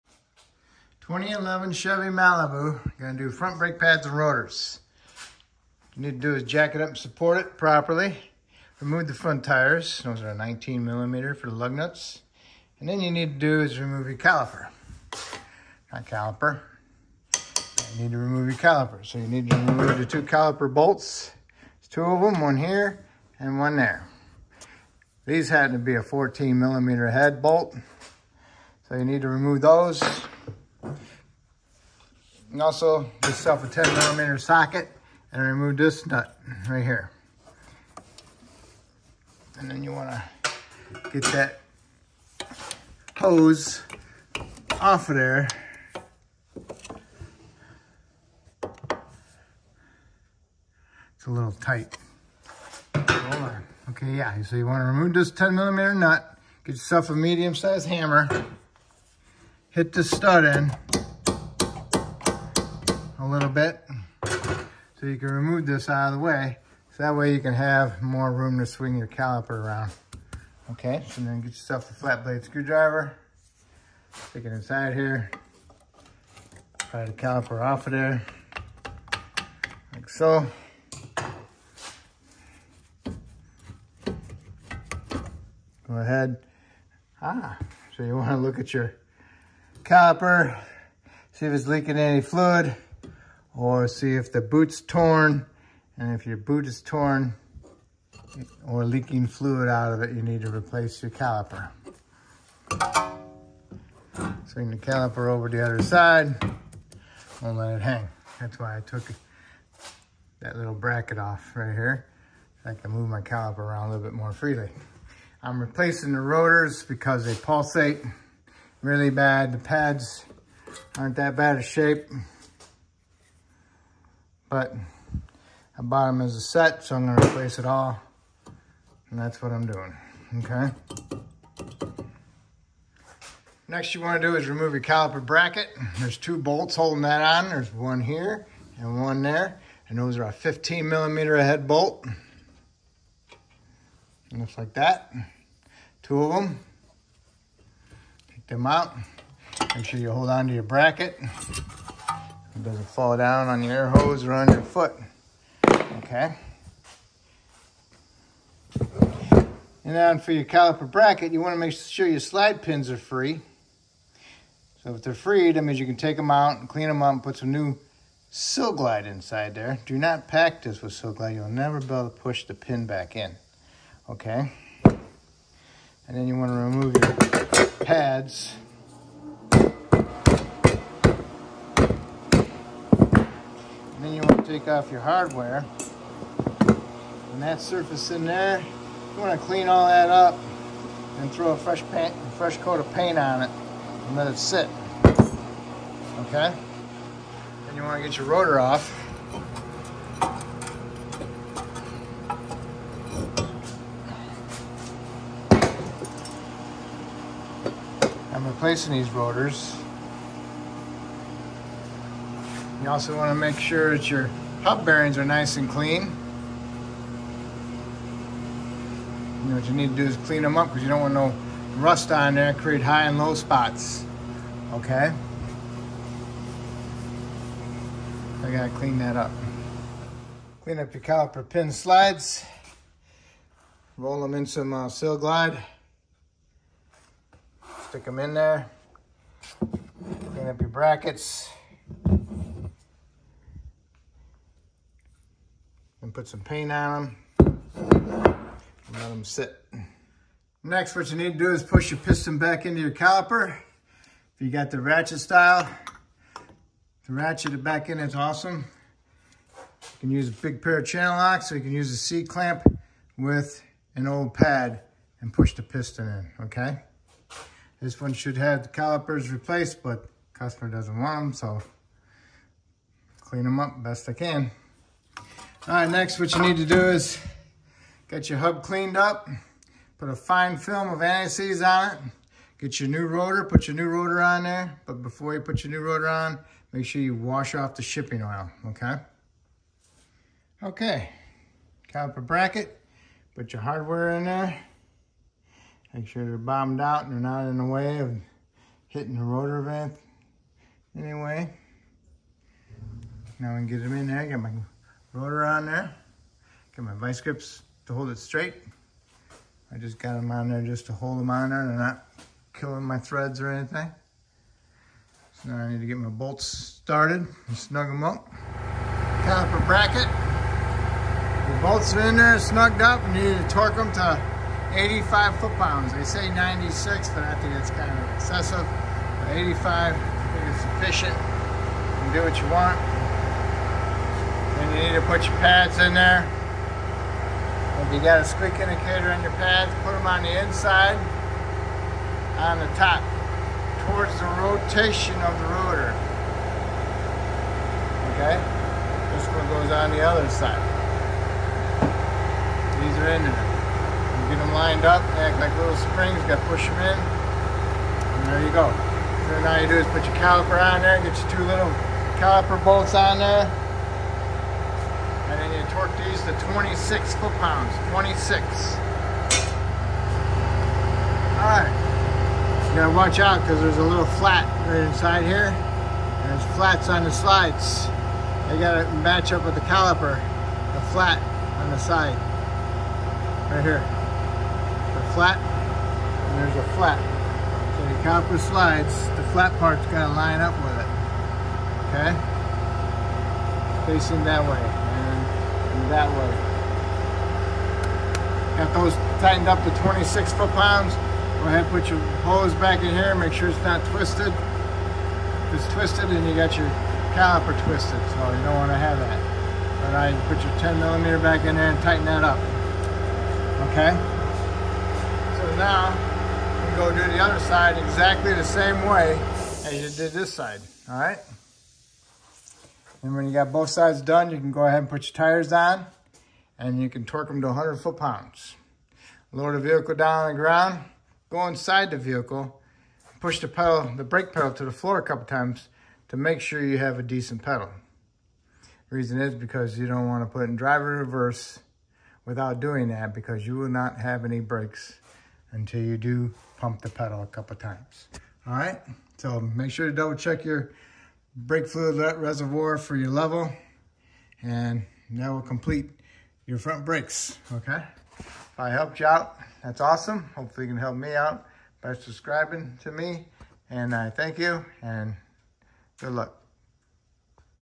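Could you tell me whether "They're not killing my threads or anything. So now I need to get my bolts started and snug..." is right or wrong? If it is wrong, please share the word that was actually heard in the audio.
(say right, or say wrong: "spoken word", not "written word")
right.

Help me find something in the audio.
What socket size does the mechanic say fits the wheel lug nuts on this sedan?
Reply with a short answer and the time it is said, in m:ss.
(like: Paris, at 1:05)
19 millimeter, at 0:10.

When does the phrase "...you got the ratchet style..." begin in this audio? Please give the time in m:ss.
4:14.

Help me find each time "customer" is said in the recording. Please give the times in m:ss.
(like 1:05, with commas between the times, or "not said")
4:30.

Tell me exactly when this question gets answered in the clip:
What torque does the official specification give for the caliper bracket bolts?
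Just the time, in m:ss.
5:26.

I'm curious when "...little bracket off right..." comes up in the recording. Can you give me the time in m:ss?
1:50.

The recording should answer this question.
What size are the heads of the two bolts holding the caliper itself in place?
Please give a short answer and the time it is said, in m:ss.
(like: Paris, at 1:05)
14 millimeter, at 0:26.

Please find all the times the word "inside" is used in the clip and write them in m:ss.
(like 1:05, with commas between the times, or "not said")
1:14, 2:49, 5:40, 6:14, 7:11.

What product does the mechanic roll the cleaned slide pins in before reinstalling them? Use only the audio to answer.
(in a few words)
Sil-Glyde.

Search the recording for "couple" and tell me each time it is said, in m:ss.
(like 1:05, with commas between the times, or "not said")
7:15, 7:27.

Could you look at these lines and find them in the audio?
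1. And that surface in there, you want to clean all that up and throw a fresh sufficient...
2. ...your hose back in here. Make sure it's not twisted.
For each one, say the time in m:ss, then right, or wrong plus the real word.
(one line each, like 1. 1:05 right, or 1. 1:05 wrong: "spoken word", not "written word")
1. 3:07 wrong: "paint", not "sufficient"
2. 6:41 right.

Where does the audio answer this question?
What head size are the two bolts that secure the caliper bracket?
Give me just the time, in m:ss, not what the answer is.
2:20.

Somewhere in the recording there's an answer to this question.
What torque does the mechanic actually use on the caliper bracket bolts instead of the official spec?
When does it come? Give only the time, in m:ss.
5:24.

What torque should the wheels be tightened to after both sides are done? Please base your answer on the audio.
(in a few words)
100 foot-pounds.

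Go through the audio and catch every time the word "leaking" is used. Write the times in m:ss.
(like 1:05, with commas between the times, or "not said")
1:31, 1:38.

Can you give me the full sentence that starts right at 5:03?
Now we can get them in there, get my rotor on there.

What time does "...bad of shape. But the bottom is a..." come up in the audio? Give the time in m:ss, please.
2:01.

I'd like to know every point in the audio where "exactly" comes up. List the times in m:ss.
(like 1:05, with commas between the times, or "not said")
6:57.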